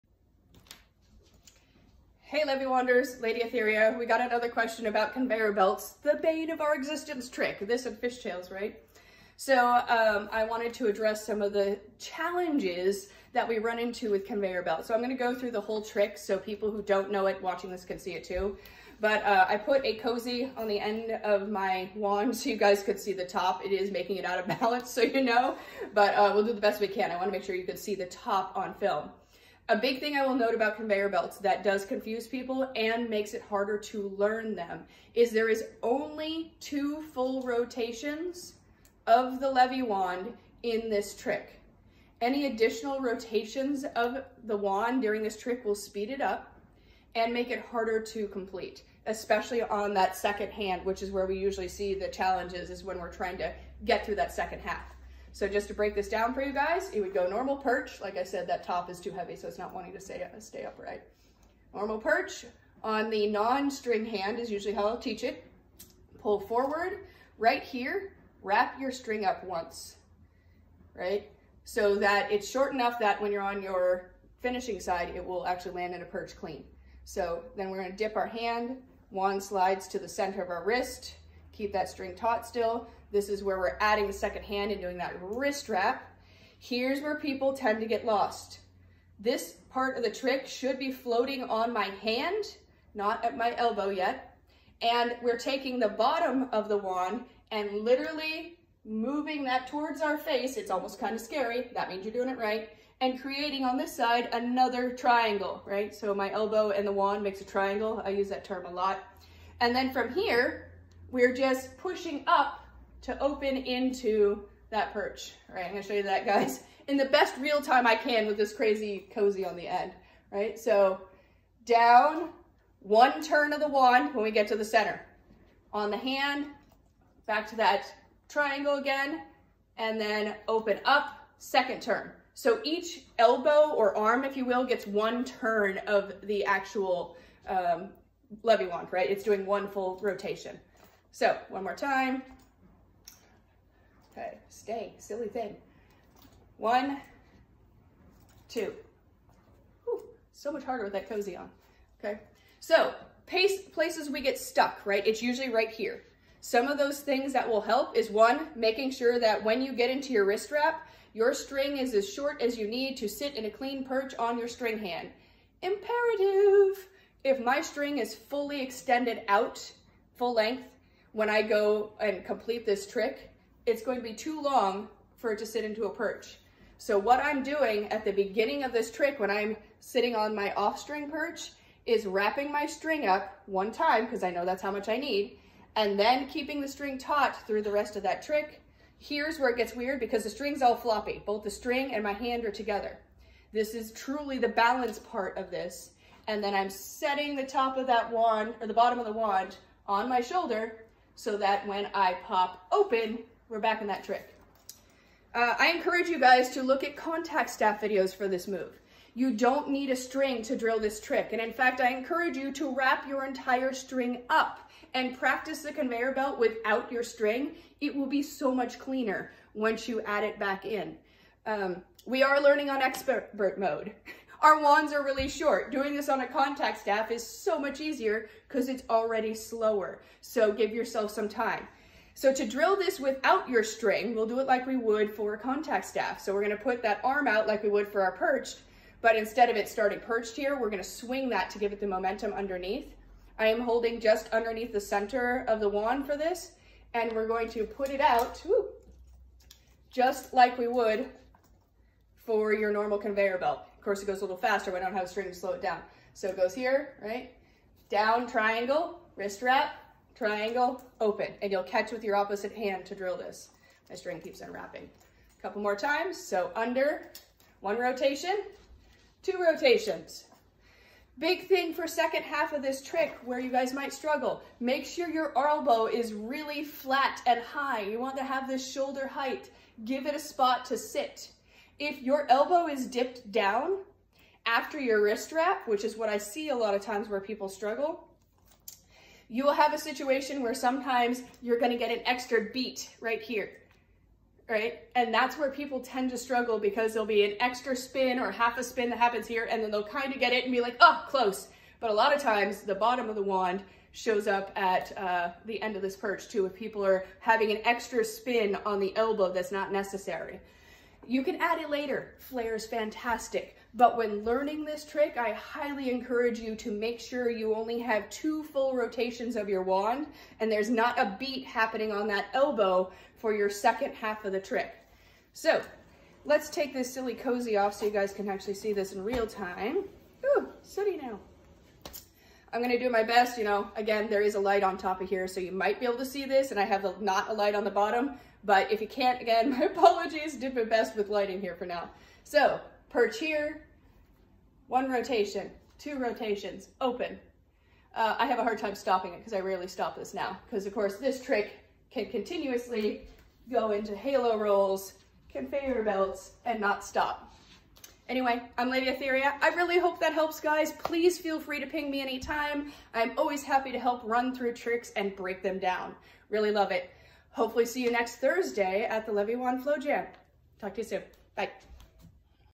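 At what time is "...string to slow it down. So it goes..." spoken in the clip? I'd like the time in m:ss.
4:15.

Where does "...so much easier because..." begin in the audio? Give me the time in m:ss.
3:47.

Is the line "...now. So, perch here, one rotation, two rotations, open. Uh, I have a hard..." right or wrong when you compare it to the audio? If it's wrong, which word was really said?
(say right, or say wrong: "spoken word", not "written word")
right.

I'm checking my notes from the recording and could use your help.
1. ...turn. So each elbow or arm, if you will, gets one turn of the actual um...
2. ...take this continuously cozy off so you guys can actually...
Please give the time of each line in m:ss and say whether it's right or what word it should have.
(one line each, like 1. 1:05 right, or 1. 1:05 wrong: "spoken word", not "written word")
1. 2:11 right
2. 5:26 wrong: "silly", not "continuously".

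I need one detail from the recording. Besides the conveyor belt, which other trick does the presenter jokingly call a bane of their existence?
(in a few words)
Fishtails.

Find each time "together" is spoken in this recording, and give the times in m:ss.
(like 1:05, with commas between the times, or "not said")
3:12.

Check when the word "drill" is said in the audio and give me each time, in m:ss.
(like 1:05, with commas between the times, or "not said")
3:30, 3:52, 4:22.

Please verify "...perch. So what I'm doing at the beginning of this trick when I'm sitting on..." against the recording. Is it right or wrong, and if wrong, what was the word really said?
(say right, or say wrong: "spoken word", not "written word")
right.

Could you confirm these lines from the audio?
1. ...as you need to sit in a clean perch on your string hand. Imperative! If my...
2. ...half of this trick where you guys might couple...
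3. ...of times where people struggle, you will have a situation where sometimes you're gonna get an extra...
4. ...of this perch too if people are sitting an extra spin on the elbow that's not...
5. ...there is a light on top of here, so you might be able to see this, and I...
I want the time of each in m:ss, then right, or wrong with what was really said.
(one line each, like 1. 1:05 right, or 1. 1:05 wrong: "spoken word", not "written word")
1. 2:42 right
2. 4:32 wrong: "struggle", not "couple"
3. 4:46 right
4. 5:05 wrong: "having", not "sitting"
5. 5:34 right.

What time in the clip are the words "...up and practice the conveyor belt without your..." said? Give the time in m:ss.
3:34.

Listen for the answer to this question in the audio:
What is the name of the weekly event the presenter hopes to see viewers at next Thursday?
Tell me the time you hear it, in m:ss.
6:09.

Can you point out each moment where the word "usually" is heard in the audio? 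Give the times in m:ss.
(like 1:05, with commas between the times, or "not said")
0:51, 1:04, 2:35.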